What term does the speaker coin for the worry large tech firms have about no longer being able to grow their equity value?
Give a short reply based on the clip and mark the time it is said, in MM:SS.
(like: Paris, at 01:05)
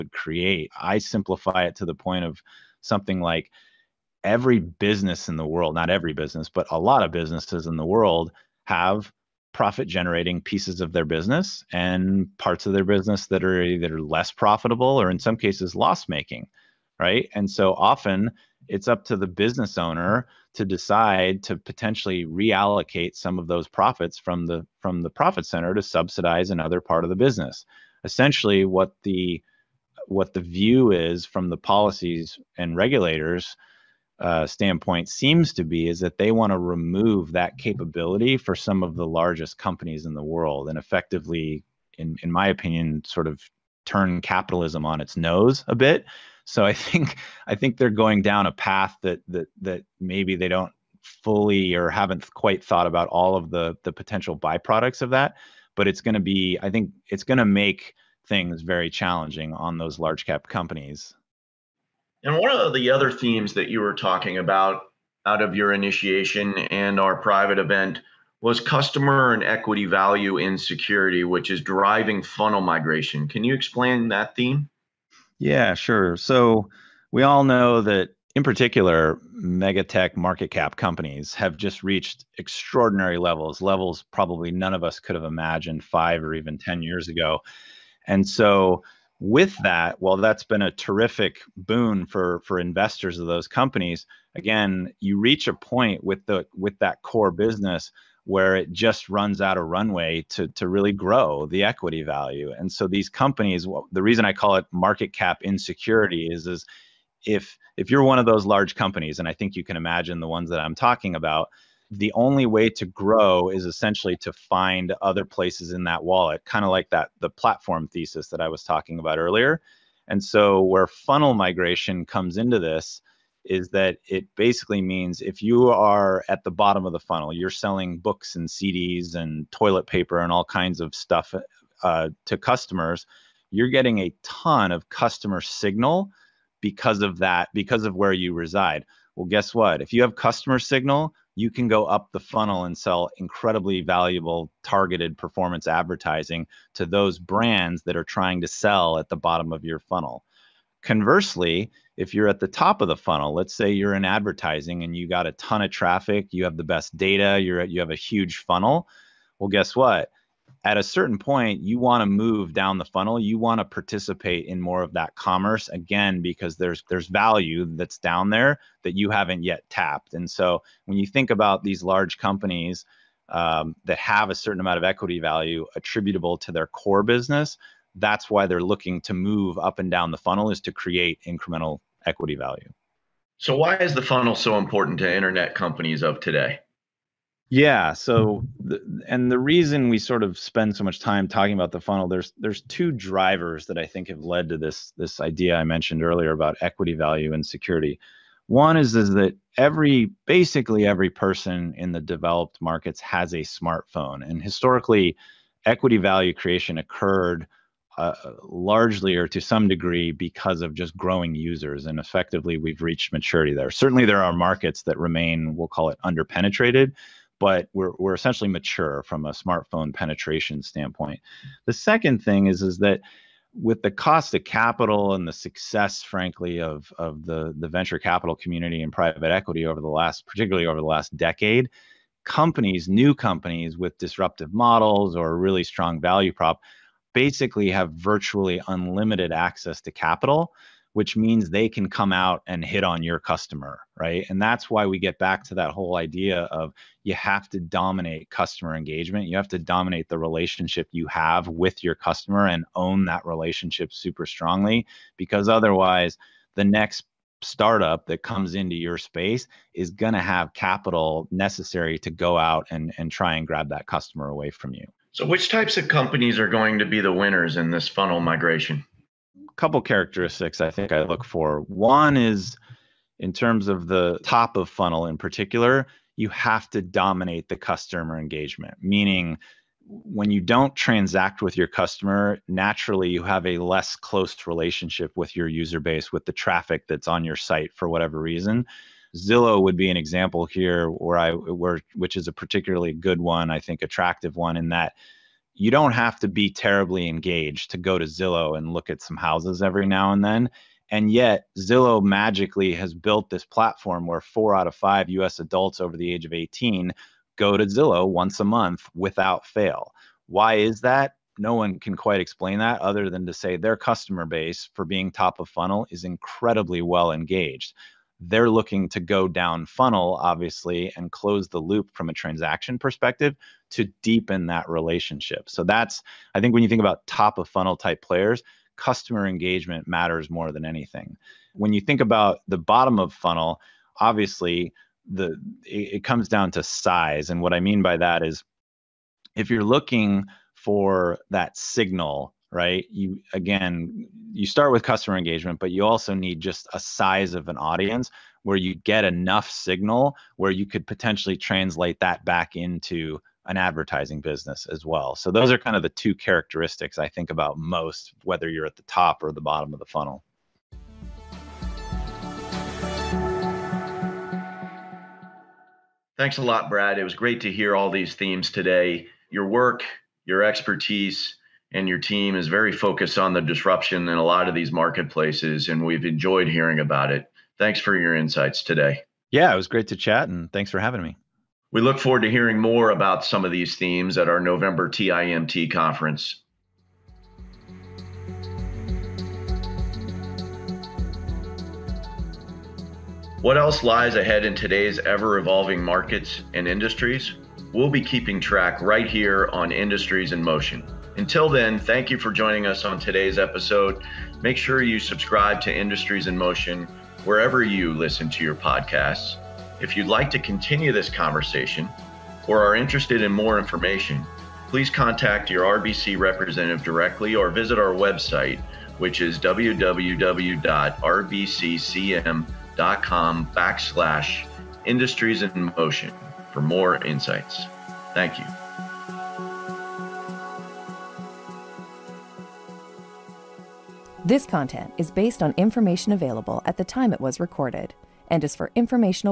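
market cap insecurity, at 01:44.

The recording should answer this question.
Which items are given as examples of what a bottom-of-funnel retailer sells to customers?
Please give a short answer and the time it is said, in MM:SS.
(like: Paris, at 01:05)
books and CDs, at 02:07.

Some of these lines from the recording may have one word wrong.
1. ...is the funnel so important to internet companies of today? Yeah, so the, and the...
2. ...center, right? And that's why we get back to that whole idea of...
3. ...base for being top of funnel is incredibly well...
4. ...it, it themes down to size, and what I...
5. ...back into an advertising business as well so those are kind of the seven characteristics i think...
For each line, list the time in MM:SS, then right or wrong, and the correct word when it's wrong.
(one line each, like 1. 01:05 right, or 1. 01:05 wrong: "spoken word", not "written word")
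1. 03:03 right
2. 04:03 wrong: "customer", not "center"
3. 05:14 right
4. 05:35 wrong: "comes", not "themes"
5. 05:52 wrong: "two", not "seven".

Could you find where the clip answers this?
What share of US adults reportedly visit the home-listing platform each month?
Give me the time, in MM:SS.
05:04.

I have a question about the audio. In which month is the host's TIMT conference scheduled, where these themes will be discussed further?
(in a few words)
November.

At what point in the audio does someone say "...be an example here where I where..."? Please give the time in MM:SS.
04:49.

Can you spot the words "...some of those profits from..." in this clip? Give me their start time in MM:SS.
00:23.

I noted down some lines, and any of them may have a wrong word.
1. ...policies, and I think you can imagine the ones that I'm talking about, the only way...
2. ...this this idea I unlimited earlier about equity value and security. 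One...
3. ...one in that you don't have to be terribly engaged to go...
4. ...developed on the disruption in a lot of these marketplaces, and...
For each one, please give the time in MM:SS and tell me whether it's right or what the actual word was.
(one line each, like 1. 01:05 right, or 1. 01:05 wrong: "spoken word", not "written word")
1. 01:48 wrong: "companies", not "policies"
2. 03:14 wrong: "mentioned", not "unlimited"
3. 04:54 right
4. 06:12 wrong: "focused", not "developed".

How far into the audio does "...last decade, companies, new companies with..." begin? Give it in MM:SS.
03:50.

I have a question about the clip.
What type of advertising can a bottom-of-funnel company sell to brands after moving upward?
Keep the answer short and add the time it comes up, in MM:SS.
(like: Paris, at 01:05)
targeted performance advertising, at 02:24.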